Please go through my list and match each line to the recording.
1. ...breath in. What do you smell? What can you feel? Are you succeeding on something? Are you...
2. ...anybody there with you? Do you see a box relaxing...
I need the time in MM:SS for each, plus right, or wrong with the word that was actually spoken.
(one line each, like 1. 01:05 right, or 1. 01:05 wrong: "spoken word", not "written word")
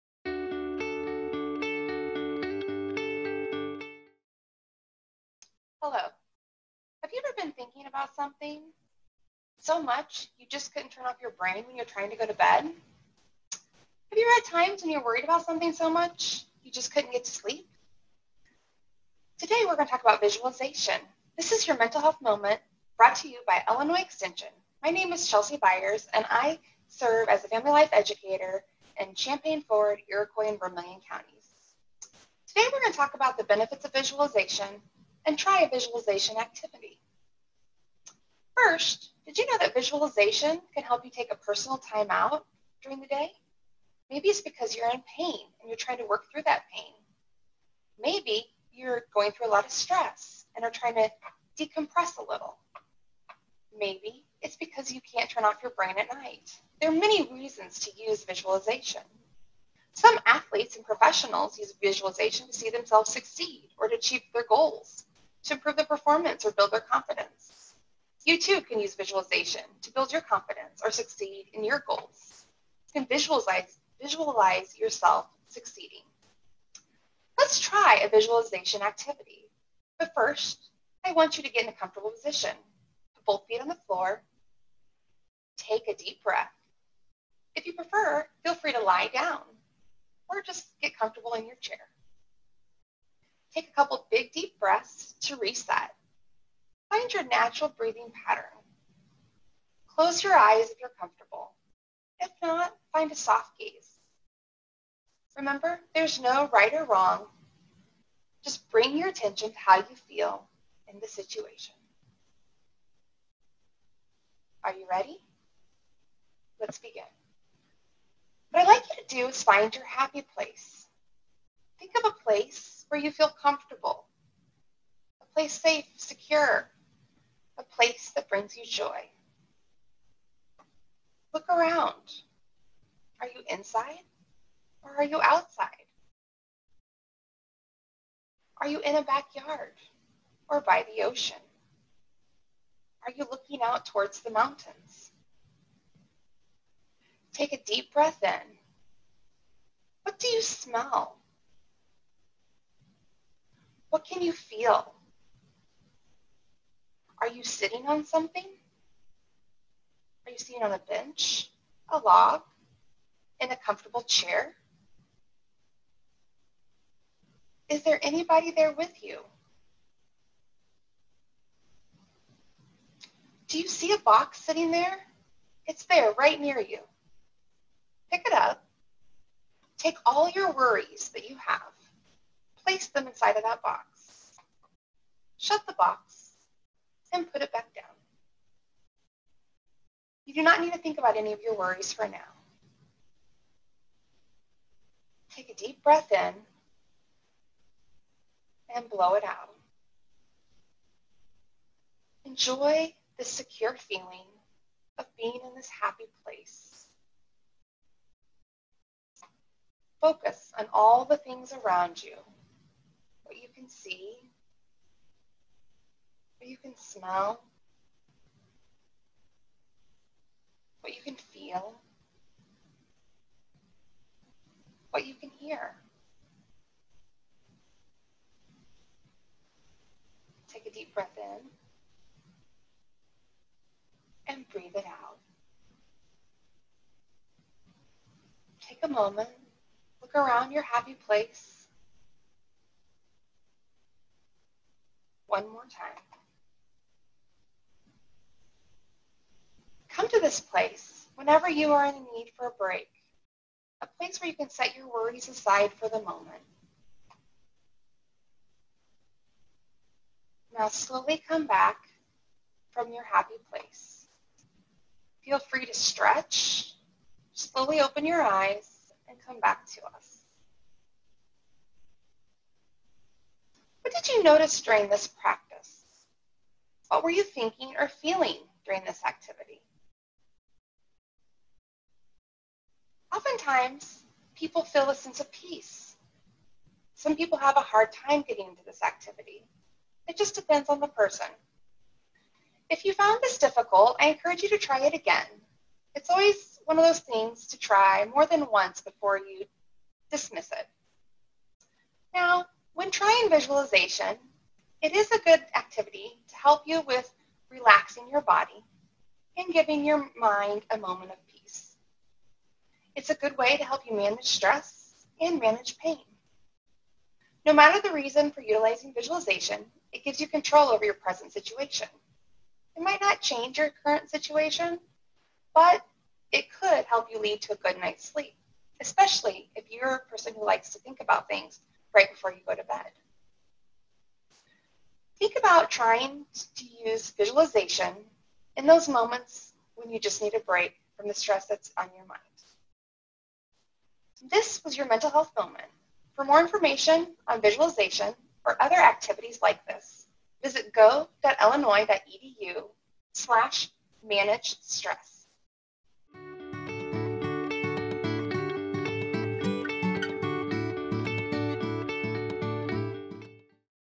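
1. 02:27 wrong: "sitting", not "succeeding"
2. 02:48 wrong: "sitting", not "relaxing".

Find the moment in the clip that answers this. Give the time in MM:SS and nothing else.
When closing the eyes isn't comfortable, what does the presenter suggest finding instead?
01:43.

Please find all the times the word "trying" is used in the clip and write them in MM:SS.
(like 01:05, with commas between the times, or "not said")
00:11, 00:45, 00:50, 05:02, 05:35.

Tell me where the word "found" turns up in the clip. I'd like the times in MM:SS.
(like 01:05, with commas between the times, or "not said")
04:52.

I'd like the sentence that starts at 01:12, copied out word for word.
You can visualize, visualize yourself succeeding.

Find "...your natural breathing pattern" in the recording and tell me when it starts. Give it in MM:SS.
01:37.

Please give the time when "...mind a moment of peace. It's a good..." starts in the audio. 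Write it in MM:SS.
05:10.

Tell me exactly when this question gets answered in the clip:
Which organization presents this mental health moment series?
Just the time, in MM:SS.
00:23.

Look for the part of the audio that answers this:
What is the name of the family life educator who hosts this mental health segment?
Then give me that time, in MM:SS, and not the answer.
00:25.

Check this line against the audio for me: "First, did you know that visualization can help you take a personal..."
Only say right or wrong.
right.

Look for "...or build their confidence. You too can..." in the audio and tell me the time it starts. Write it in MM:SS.
01:06.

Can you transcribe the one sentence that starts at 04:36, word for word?
What were you thinking or feeling during this activity?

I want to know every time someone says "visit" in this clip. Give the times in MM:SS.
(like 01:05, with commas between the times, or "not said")
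05:50.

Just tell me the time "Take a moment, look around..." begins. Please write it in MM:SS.
03:58.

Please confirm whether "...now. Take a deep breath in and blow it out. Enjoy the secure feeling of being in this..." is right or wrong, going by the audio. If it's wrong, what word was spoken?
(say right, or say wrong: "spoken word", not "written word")
right.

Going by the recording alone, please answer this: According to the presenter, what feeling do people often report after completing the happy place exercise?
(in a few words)
A sense of peace.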